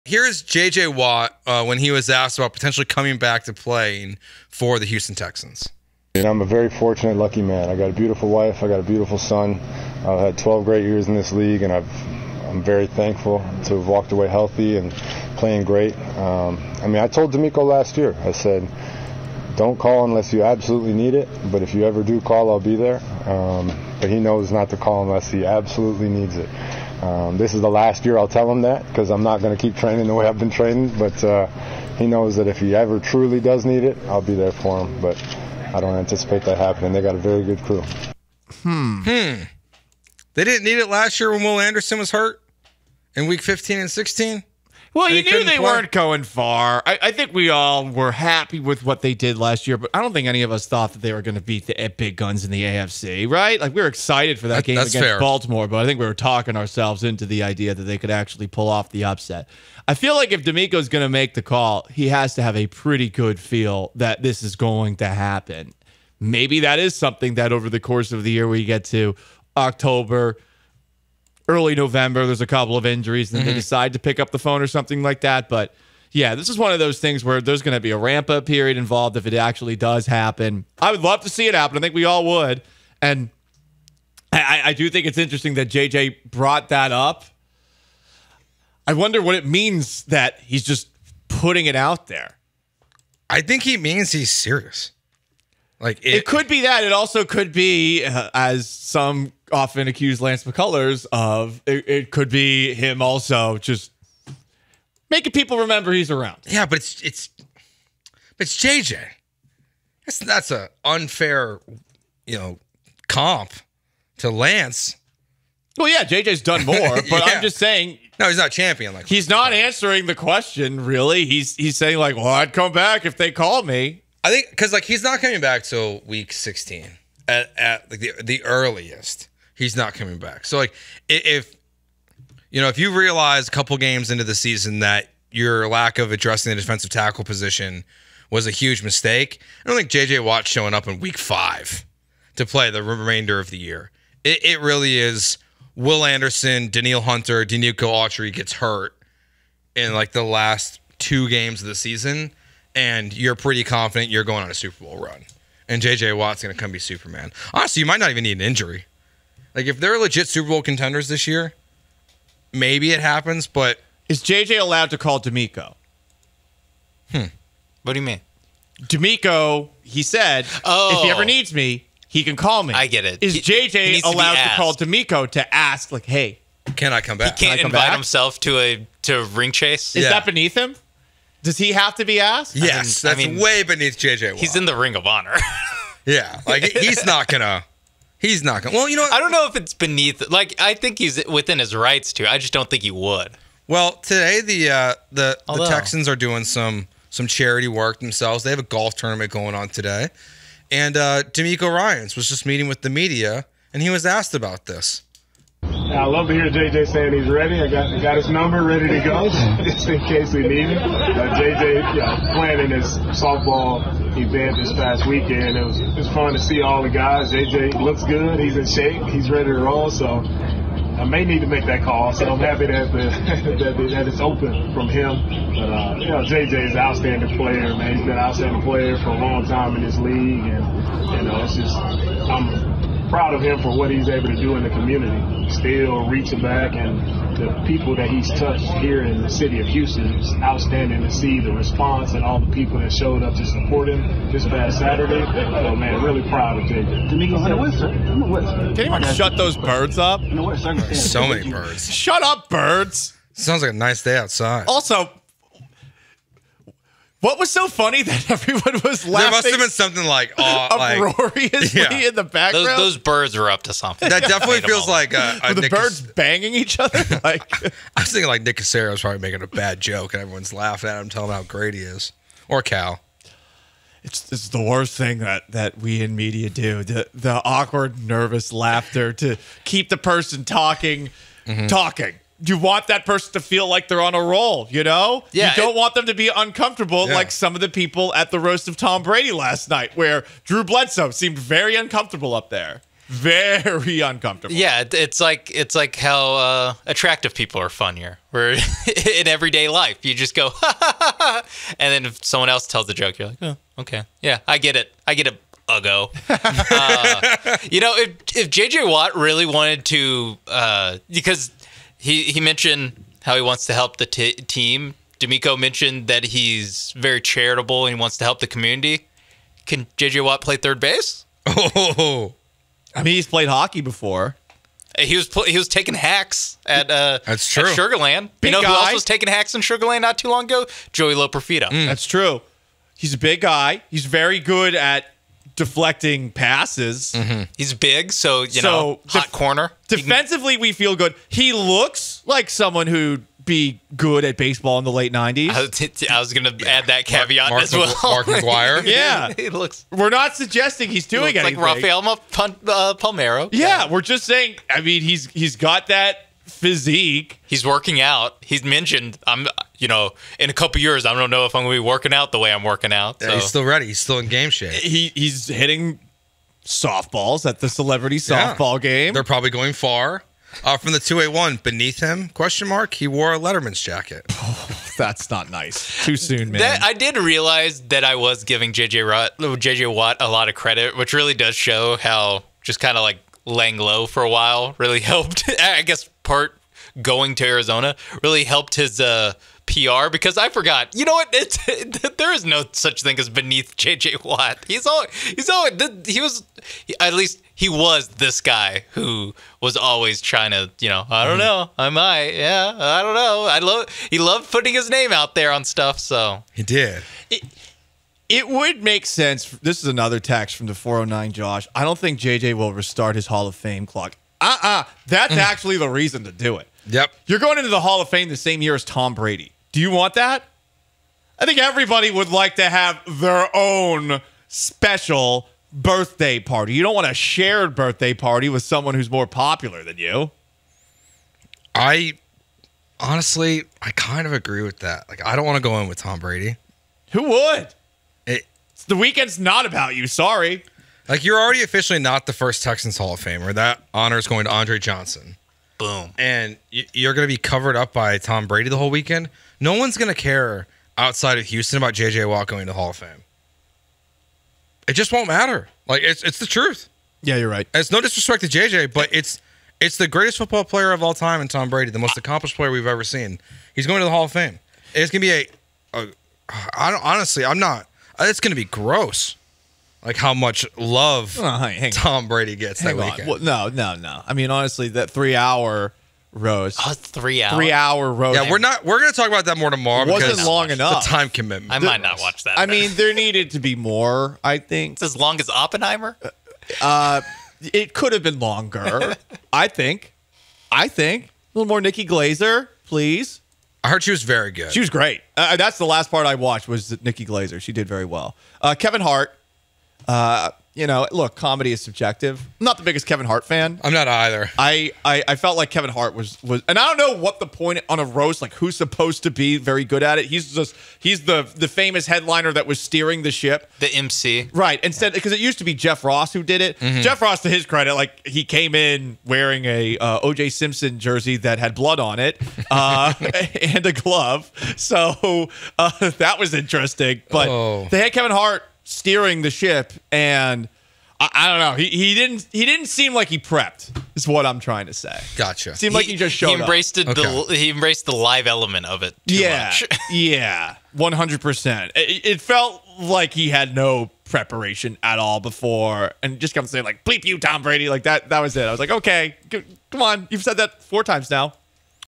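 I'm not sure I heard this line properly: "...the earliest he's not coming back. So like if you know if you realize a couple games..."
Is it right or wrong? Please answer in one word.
right.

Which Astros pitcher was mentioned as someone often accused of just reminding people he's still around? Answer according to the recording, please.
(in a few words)
Lance McCullers.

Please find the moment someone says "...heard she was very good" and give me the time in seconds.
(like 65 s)
493 s.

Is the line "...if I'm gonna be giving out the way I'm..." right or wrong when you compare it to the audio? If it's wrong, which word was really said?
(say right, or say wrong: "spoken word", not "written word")
wrong: "working", not "giving".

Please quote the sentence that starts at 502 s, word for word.
I'm not the biggest Kevin Hart fan.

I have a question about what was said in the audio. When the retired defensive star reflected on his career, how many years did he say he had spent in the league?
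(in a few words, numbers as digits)
12.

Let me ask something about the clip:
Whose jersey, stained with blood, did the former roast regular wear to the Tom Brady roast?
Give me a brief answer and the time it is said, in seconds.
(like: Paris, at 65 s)
O.J. Simpson, at 520 s.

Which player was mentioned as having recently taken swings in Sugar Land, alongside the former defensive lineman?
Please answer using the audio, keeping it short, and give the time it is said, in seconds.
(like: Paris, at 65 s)
Joey Loperfido, at 330 s.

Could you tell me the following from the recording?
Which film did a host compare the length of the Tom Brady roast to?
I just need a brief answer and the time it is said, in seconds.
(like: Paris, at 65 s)
Oppenheimer, at 485 s.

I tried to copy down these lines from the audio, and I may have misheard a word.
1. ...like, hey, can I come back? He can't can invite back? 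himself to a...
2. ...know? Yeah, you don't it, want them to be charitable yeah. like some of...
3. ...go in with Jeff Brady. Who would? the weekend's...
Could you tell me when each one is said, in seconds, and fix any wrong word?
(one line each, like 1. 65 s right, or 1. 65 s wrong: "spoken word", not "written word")
1. 175 s right
2. 284 s wrong: "uncomfortable", not "charitable"
3. 435 s wrong: "Tom", not "Jeff".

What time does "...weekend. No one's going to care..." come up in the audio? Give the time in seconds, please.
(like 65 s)
448 s.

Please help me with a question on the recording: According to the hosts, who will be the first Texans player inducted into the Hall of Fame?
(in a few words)
Andre Johnson.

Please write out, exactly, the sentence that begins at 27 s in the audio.
Um, this is the last year I'll tell him that because I'm not going to keep training the way I've been training.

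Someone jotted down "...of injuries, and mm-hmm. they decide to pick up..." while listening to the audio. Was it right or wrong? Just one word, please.
right.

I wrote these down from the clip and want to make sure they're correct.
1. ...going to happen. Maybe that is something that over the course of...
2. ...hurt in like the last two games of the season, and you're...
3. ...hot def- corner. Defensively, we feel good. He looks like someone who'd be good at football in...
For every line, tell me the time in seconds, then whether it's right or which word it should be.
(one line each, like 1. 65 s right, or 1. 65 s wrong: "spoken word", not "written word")
1. 64 s right
2. 148 s right
3. 339 s wrong: "baseball", not "football".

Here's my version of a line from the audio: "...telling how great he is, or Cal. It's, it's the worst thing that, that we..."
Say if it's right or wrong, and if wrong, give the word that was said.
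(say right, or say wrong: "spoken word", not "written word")
right.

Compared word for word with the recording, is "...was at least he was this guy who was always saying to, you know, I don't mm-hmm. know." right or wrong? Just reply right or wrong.
wrong.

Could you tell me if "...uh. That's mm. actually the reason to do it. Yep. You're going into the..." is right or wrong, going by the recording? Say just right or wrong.
right.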